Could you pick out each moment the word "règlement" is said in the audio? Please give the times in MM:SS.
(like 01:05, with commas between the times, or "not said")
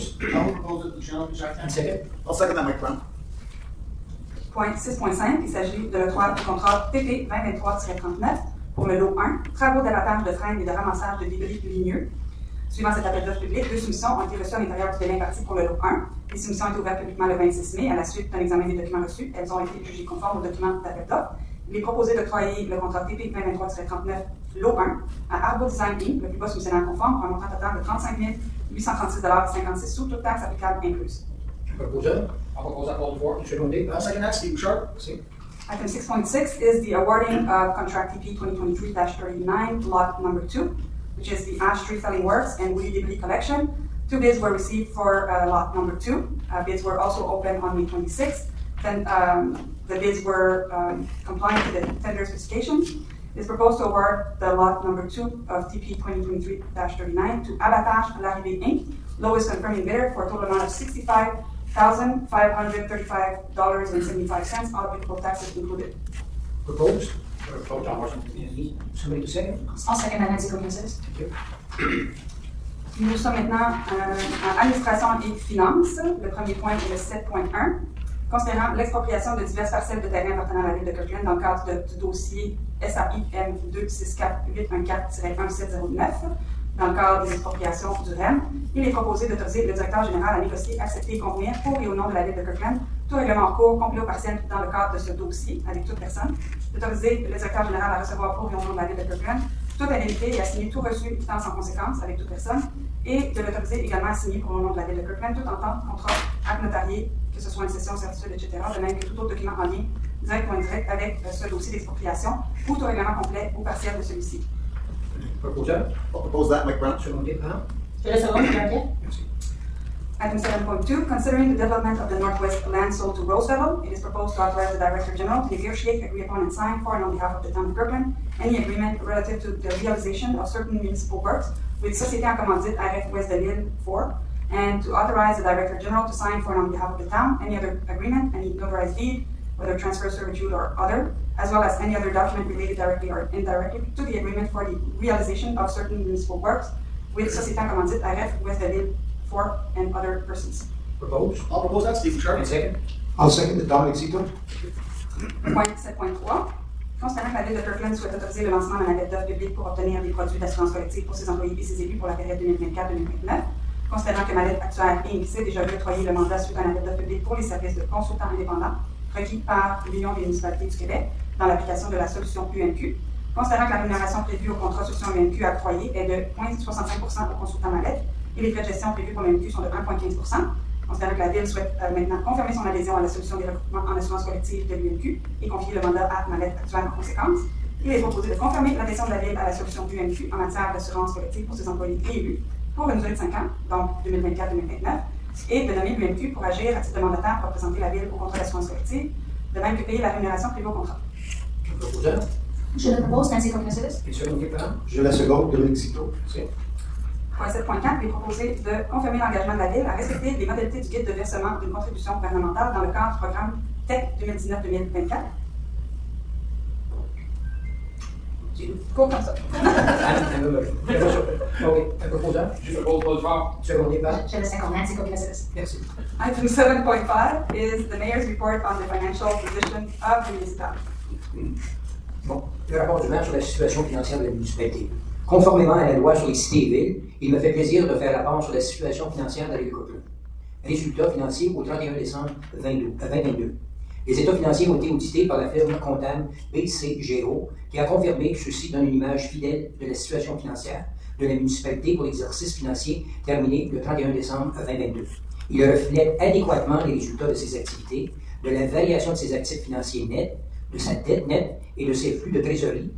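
01:33, 01:52.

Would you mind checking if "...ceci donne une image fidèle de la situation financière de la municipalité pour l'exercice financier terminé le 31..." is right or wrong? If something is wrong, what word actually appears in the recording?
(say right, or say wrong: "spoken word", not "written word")
right.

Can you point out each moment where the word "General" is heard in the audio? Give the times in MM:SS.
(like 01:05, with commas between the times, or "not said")
02:05, 02:15.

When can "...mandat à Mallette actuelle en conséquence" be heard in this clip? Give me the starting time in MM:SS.
03:05.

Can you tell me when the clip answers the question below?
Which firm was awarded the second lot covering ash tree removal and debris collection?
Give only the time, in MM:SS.
00:57.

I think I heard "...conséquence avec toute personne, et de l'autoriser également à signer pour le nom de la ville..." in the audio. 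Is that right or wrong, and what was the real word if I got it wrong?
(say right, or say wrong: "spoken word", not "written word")
right.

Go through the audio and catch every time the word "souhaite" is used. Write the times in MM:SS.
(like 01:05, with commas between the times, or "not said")
02:37, 03:01.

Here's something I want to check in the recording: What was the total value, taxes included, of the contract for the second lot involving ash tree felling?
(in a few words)
$65,535.75.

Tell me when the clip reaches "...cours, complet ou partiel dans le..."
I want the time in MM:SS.
01:33.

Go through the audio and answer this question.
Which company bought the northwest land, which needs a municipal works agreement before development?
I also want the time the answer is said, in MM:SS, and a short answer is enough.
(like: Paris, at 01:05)
Rosefellow, at 02:03.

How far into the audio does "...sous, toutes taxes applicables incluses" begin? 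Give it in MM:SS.
00:29.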